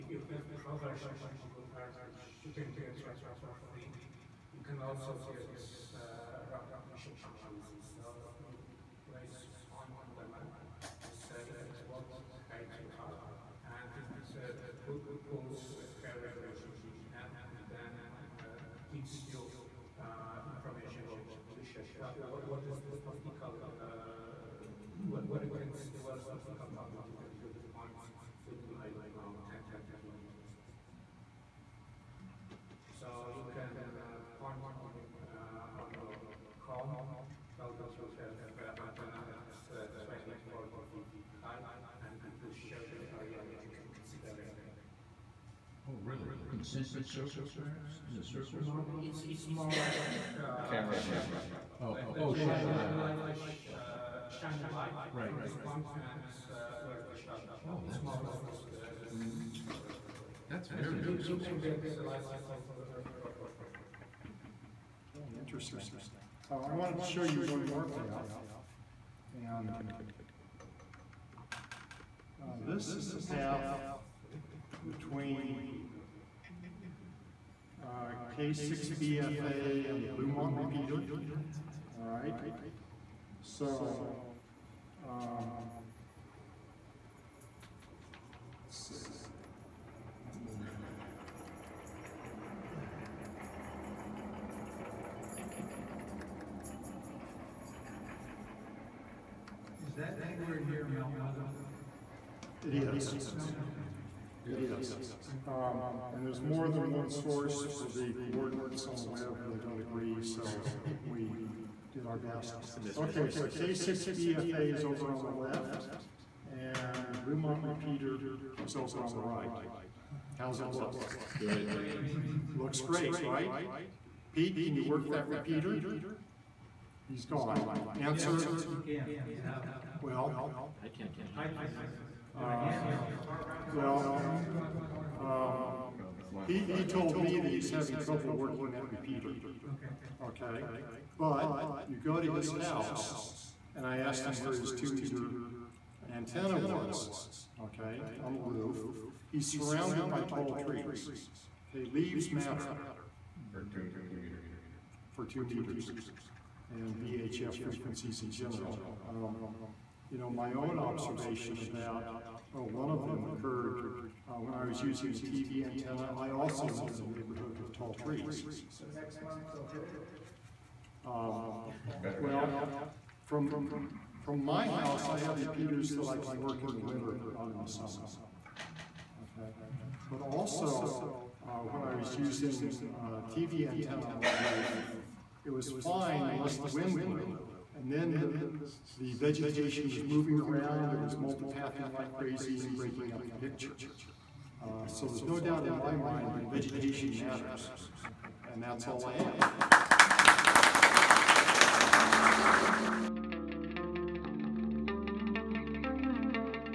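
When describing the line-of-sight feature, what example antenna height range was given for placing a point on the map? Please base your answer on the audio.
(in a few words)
20 to 40 feet.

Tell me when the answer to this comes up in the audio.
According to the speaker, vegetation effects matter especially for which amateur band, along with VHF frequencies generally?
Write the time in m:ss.
2:35.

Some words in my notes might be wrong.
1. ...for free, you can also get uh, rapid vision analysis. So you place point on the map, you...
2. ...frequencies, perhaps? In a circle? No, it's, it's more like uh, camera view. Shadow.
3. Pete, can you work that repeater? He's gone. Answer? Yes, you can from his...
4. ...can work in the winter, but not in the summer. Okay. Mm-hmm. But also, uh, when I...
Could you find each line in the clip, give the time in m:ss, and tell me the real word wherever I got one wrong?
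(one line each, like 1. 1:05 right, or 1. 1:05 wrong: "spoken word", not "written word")
1. 0:03 right
2. 0:47 wrong: "circles", not "frequencies"
3. 2:04 right
4. 2:56 right.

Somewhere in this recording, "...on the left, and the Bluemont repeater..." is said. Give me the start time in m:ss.
1:55.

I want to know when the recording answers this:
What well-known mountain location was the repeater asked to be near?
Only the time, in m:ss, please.
1:40.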